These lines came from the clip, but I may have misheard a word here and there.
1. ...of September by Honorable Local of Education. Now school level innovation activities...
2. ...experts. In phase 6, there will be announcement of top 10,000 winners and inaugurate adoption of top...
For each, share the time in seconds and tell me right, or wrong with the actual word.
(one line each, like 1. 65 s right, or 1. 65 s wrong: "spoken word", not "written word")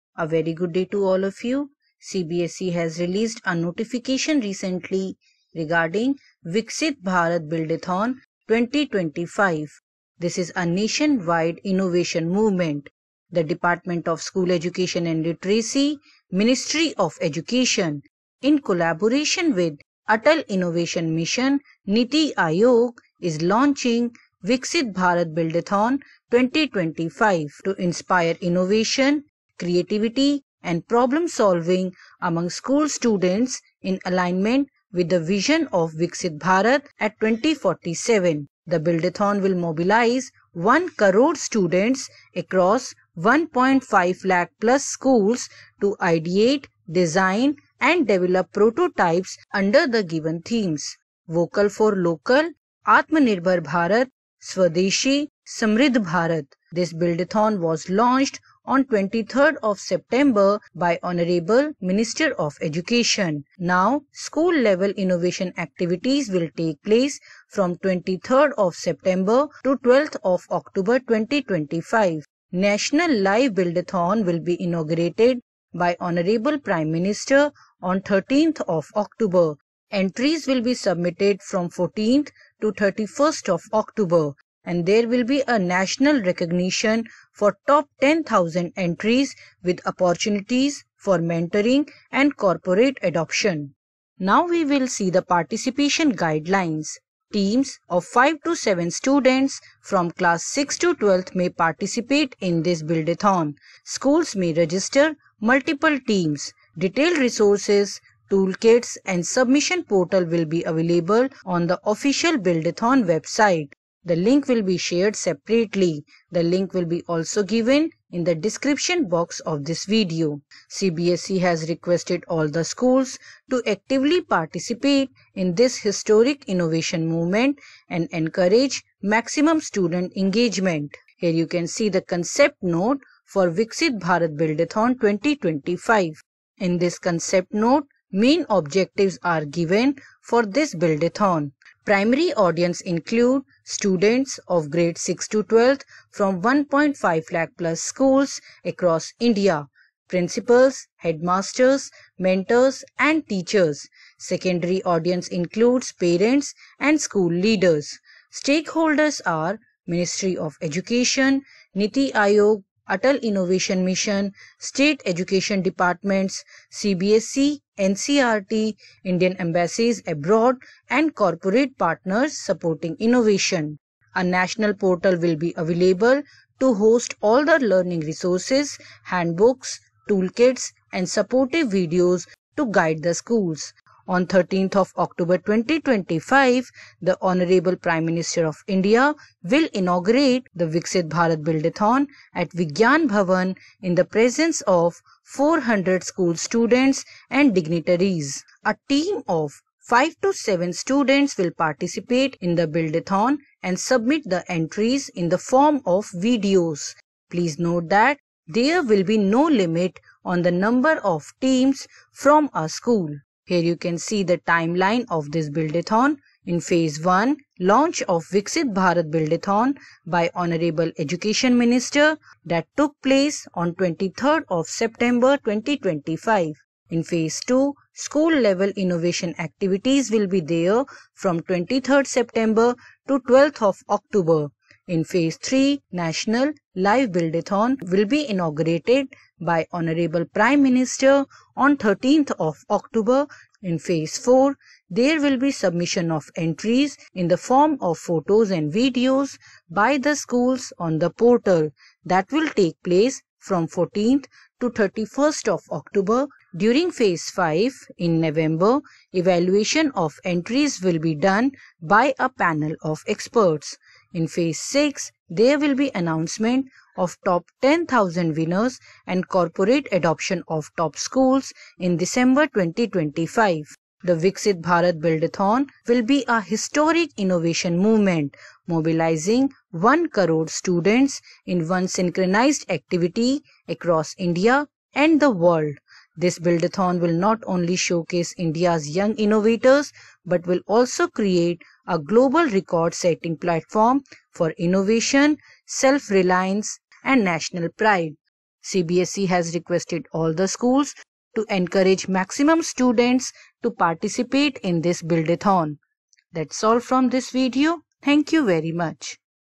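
1. 59 s wrong: "Minister", not "Local"
2. 263 s wrong: "corporate", not "inaugurate".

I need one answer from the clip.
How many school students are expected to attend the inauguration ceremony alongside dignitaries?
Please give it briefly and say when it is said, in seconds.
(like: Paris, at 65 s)
400, at 195 s.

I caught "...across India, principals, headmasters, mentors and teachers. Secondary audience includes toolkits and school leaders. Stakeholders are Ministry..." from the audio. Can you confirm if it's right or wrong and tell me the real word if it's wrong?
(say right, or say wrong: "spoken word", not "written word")
wrong: "parents", not "toolkits".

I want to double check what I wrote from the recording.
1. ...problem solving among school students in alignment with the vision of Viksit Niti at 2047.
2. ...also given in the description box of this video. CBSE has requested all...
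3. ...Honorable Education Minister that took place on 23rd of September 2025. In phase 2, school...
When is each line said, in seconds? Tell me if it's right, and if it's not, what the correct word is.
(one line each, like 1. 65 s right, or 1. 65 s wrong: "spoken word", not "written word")
1. 30 s wrong: "Bharat", not "Niti"
2. 117 s right
3. 220 s right.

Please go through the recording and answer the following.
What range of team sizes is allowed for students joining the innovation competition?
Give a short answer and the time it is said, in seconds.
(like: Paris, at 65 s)
5 to 7 students, at 97 s.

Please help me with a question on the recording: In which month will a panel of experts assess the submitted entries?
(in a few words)
November.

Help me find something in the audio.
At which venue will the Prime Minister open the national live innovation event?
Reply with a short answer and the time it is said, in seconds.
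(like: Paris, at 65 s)
Vigyan Bhavan, at 192 s.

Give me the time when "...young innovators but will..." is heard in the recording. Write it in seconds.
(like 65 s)
288 s.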